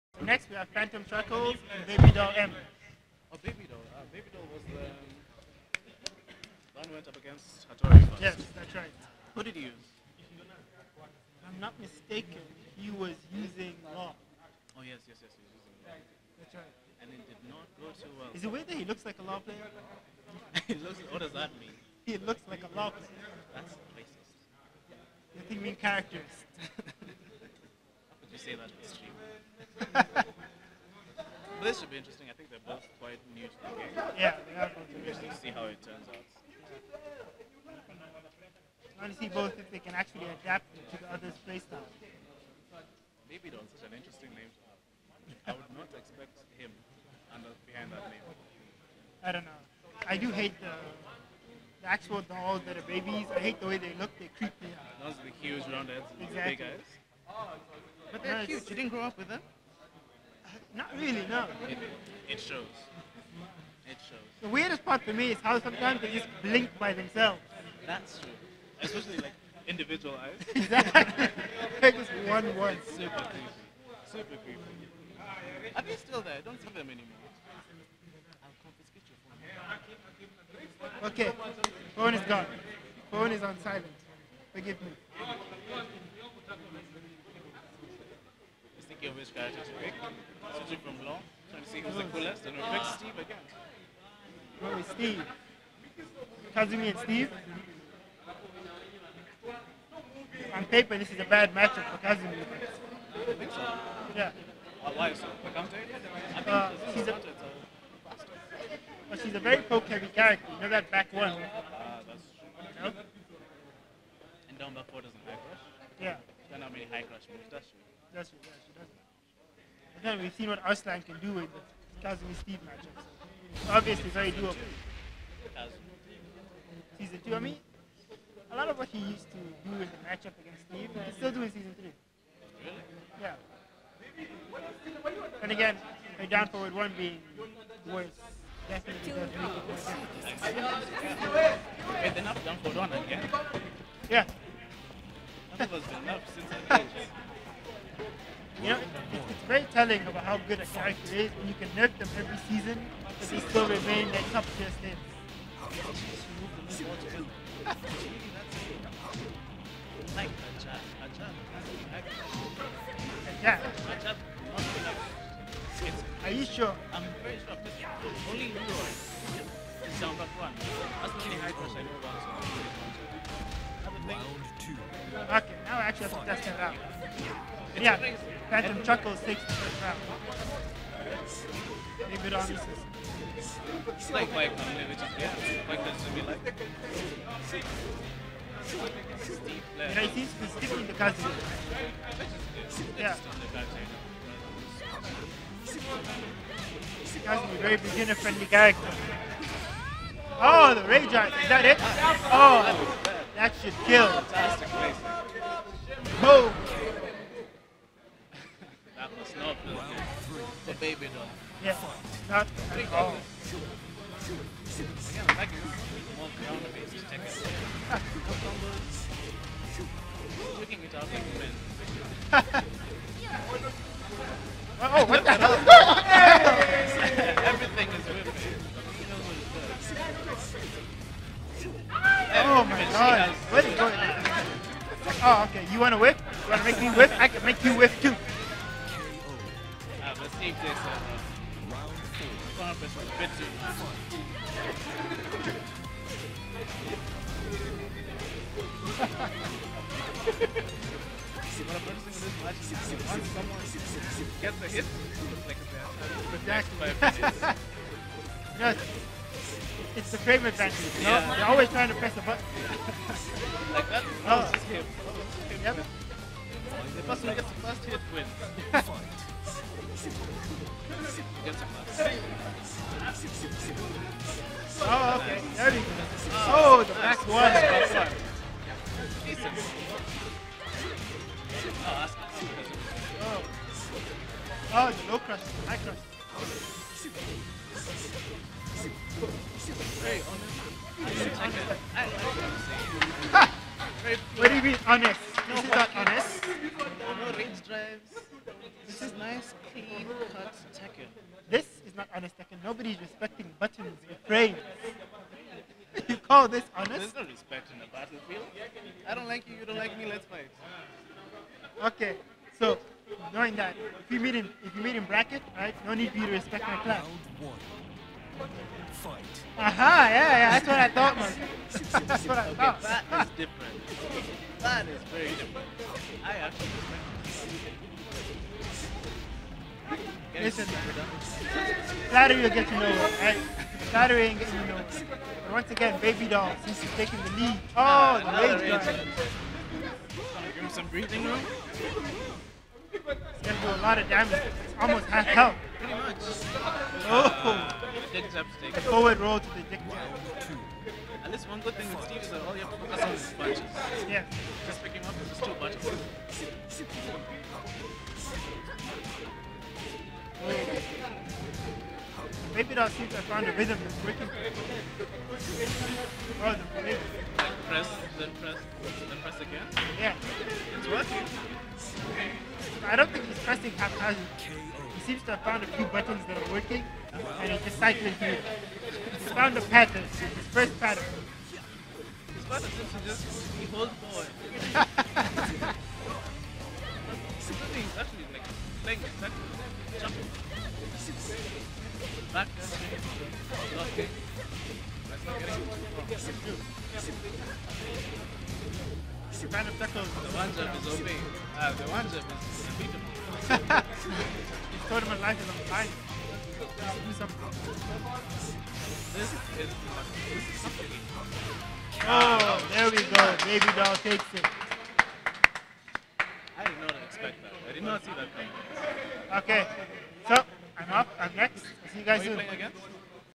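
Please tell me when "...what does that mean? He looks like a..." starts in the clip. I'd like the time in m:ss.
0:21.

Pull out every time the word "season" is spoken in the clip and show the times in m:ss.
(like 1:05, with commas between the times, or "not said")
2:06, 2:11, 2:32.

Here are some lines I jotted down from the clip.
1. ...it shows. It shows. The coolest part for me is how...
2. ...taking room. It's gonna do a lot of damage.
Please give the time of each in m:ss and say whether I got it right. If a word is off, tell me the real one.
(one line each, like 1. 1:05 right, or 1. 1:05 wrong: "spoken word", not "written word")
1. 1:02 wrong: "weirdest", not "coolest"
2. 5:40 wrong: "breathing", not "taking".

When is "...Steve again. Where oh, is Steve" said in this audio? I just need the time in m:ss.
1:32.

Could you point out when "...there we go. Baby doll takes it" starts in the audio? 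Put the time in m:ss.
6:52.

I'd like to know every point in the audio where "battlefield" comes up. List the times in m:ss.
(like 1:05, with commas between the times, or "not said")
5:07.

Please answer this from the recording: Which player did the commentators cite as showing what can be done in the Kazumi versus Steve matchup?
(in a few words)
Arslan.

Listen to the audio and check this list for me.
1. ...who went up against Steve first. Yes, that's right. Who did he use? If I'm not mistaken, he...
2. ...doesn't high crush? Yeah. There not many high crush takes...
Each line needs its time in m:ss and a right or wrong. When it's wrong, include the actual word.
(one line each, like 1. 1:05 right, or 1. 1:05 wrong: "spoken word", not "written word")
1. 0:06 wrong: "Hattori", not "Steve"
2. 1:55 wrong: "moves", not "takes".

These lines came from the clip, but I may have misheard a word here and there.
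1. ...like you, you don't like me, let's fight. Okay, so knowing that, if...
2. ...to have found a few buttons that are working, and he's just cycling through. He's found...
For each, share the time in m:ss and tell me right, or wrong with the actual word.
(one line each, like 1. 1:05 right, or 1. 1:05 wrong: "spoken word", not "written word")
1. 5:09 right
2. 6:15 right.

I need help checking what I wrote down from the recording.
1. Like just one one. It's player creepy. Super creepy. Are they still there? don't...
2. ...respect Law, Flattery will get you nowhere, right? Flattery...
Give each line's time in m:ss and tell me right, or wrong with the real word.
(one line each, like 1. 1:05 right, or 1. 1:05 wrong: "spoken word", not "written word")
1. 1:11 wrong: "super", not "player"
2. 5:26 wrong: "Listen", not "Law".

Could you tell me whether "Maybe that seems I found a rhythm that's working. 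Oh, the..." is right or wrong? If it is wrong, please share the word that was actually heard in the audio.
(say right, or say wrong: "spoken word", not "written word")
right.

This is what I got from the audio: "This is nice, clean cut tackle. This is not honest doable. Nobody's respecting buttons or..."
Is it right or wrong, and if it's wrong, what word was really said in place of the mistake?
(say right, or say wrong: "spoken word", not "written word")
wrong: "tackle", not "doable".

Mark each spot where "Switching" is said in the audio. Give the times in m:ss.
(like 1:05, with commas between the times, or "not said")
1:30.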